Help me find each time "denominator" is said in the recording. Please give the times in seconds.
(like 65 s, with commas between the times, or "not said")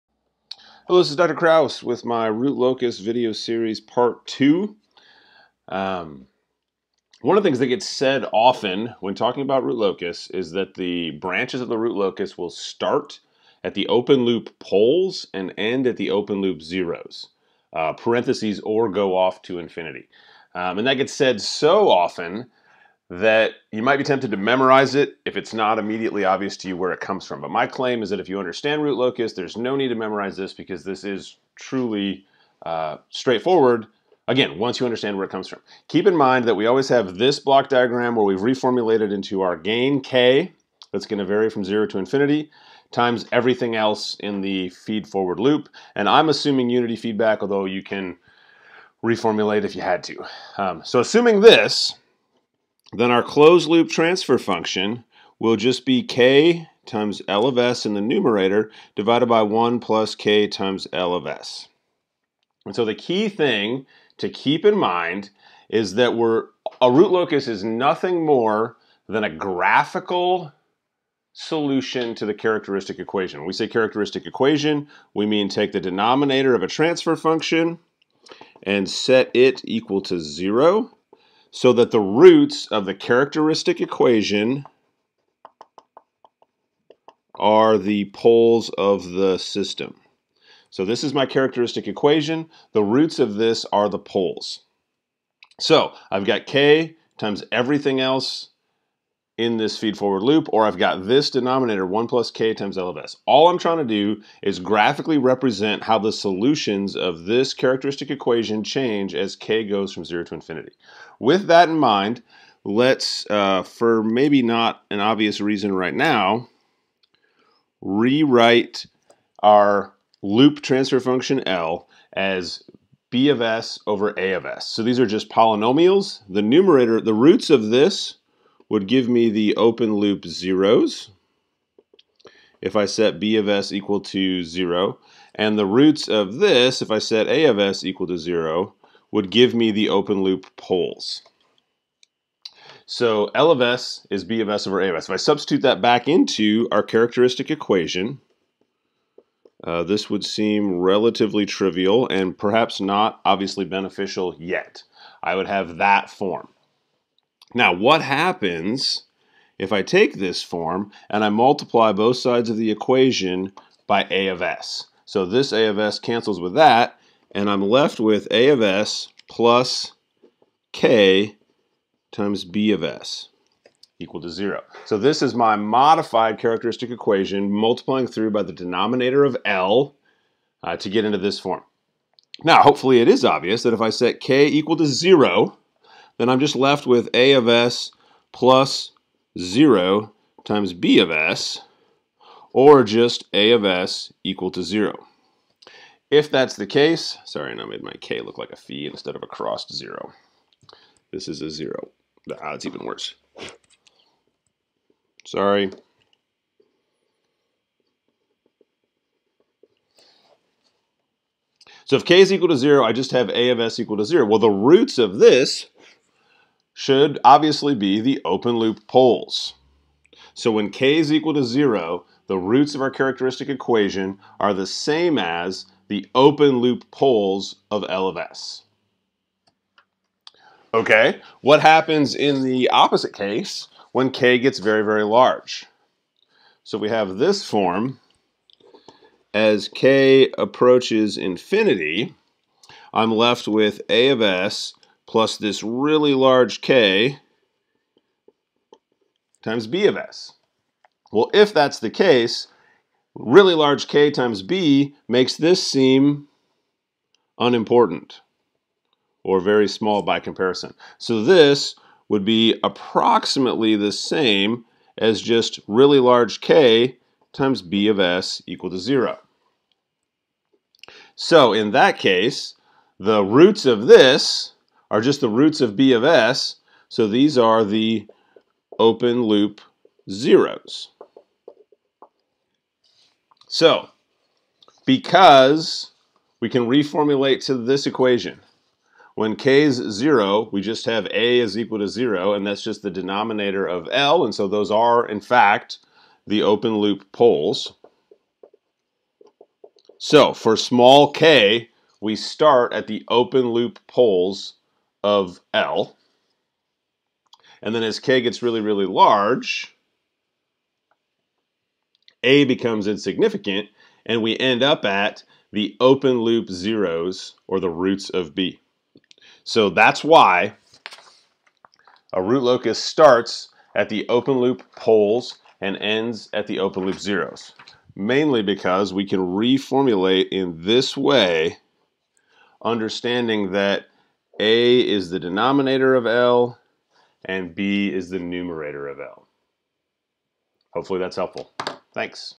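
75 s, 101 s, 178 s, 292 s, 335 s.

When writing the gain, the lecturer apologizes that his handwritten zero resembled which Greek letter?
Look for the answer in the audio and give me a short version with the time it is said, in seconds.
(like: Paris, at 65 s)
Phi, at 198 s.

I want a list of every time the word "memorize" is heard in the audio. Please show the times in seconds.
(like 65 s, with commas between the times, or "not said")
24 s, 29 s.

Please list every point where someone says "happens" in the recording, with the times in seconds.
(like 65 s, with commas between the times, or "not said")
158 s, 231 s.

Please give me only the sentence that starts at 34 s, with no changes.
Again, once you understand where it comes from.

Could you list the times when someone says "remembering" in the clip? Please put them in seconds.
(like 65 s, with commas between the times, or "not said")
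not said.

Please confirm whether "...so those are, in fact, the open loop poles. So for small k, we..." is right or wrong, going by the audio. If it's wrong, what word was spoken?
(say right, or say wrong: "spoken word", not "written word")
right.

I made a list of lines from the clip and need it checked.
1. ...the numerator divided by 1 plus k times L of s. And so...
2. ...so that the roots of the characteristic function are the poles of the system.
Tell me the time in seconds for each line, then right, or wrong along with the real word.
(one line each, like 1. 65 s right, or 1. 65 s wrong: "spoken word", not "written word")
1. 57 s right
2. 81 s wrong: "equation", not "function".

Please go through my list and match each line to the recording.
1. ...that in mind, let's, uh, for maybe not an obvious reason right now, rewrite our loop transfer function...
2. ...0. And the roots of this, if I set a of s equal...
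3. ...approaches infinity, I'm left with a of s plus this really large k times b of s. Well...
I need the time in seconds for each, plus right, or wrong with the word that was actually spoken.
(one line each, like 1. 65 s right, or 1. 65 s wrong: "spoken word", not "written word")
1. 111 s right
2. 134 s right
3. 240 s right.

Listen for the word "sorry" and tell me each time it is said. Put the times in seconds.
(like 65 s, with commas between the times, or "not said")
197 s, 205 s.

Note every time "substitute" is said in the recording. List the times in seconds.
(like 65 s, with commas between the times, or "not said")
145 s.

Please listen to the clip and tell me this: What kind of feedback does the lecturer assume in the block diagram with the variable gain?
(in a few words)
Unity feedback.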